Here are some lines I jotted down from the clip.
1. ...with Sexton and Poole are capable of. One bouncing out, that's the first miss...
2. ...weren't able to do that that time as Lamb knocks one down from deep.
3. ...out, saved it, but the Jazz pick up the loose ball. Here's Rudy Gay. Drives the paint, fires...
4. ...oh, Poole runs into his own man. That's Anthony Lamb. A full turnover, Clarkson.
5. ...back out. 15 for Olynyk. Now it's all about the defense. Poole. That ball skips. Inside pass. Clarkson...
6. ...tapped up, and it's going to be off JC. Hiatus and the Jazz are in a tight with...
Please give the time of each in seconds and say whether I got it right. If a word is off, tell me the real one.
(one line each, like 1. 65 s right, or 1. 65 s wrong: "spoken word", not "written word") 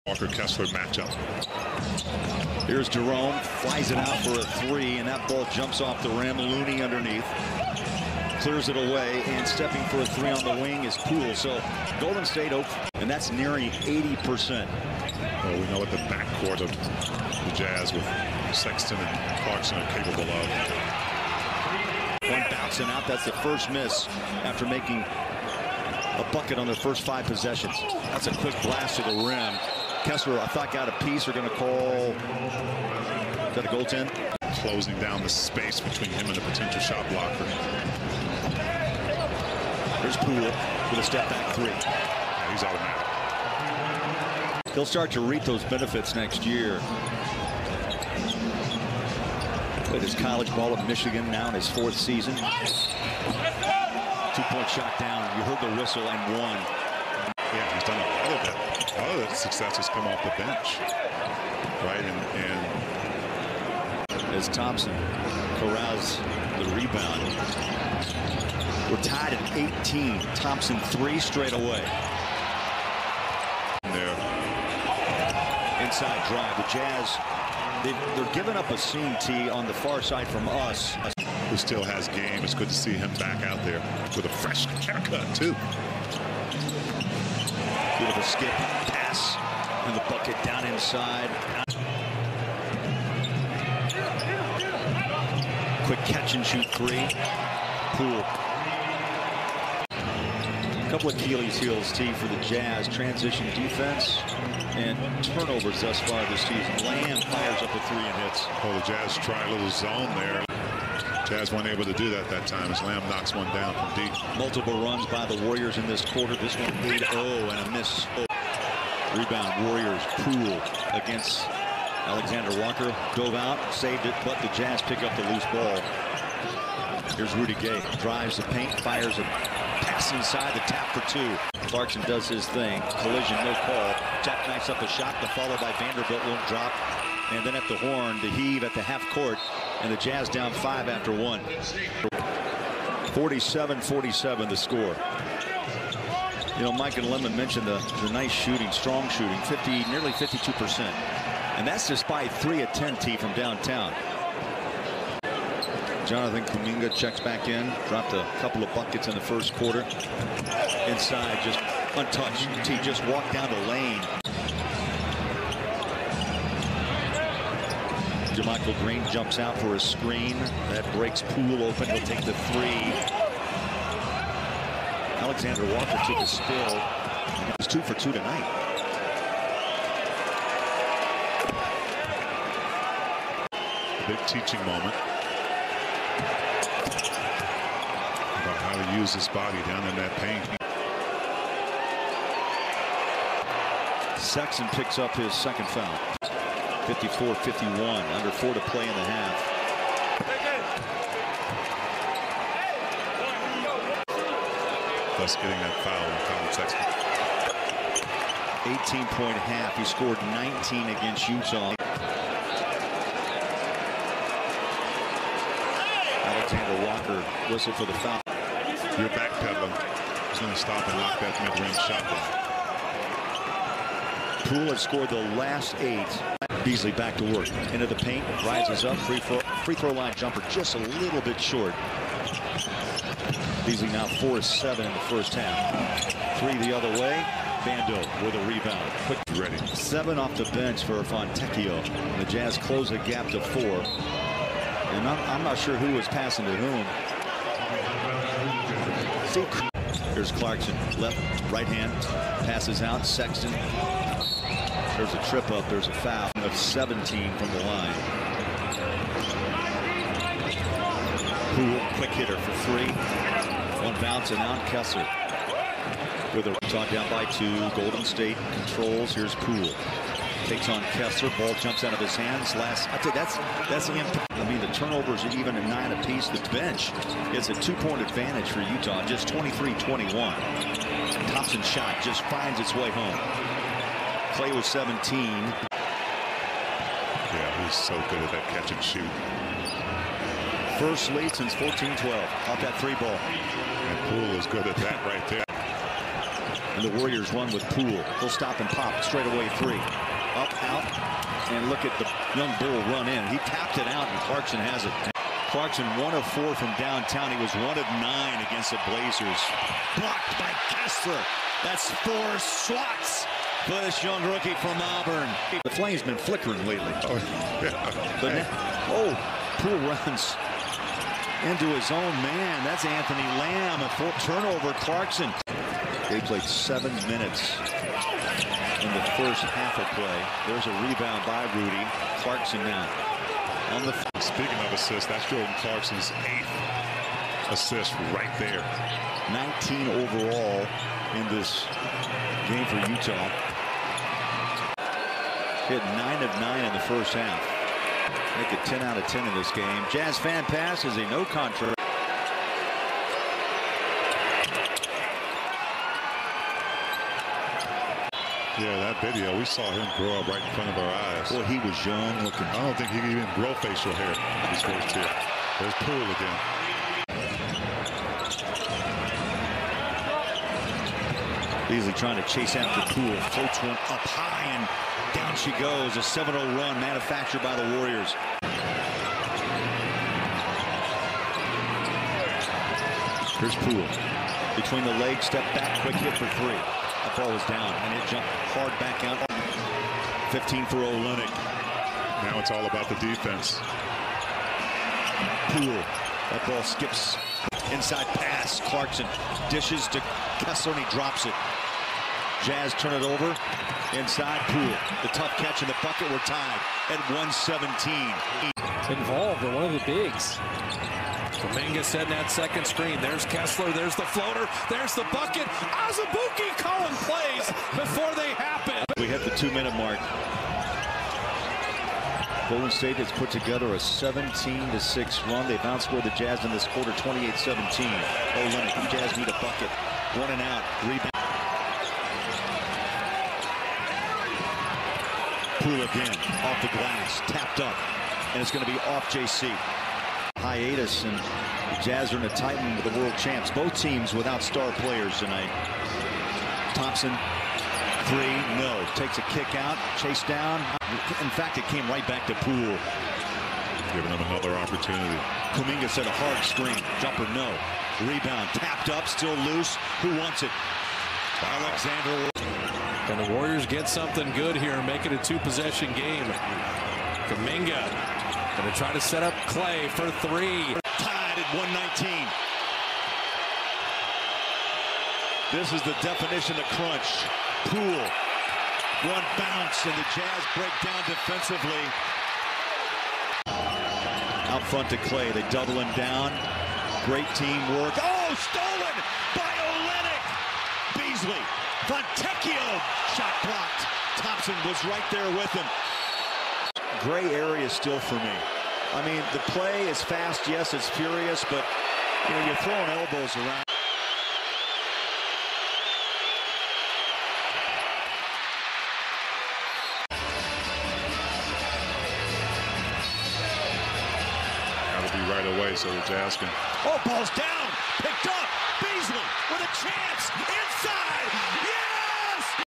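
1. 17 s wrong: "Clarkson", not "Poole"
2. 111 s right
3. 123 s right
4. 318 s right
5. 388 s right
6. 437 s right.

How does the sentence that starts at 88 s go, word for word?
Beautiful skip, pass, and the bucket down inside.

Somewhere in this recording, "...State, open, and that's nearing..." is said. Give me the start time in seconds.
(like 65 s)
12 s.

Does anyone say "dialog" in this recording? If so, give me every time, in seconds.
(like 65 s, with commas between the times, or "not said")
not said.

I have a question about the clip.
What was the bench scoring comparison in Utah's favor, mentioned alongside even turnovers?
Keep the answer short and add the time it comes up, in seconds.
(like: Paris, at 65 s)
23-21, at 279 s.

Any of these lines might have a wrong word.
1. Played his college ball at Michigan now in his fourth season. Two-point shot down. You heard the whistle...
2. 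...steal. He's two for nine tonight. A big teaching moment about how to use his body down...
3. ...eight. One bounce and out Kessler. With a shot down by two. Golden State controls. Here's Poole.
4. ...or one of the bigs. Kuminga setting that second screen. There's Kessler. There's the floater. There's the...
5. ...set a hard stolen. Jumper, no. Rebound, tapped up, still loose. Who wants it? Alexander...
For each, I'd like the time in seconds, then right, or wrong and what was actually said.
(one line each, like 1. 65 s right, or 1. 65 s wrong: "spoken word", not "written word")
1. 49 s right
2. 176 s wrong: "two", not "nine"
3. 262 s wrong: "three", not "eight"
4. 409 s right
5. 455 s wrong: "screen", not "stolen".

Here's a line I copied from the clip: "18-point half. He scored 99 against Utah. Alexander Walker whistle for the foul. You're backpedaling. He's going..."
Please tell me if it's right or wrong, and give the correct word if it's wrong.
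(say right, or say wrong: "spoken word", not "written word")
wrong: "19", not "99".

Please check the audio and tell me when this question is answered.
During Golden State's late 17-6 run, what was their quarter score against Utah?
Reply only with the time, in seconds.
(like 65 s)
426 s.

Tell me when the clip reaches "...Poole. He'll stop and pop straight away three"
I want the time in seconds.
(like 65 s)
297 s.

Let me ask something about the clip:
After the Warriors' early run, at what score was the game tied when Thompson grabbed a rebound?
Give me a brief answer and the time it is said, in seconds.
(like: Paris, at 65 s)
18, at 69 s.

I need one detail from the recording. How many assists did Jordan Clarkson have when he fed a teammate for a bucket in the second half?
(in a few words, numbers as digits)
8.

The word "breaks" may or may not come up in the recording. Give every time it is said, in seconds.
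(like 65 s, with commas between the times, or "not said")
170 s, 480 s.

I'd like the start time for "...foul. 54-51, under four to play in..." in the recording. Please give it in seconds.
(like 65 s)
195 s.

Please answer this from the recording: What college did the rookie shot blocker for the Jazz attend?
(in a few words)
Auburn.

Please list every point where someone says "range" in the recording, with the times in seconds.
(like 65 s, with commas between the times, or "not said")
224 s.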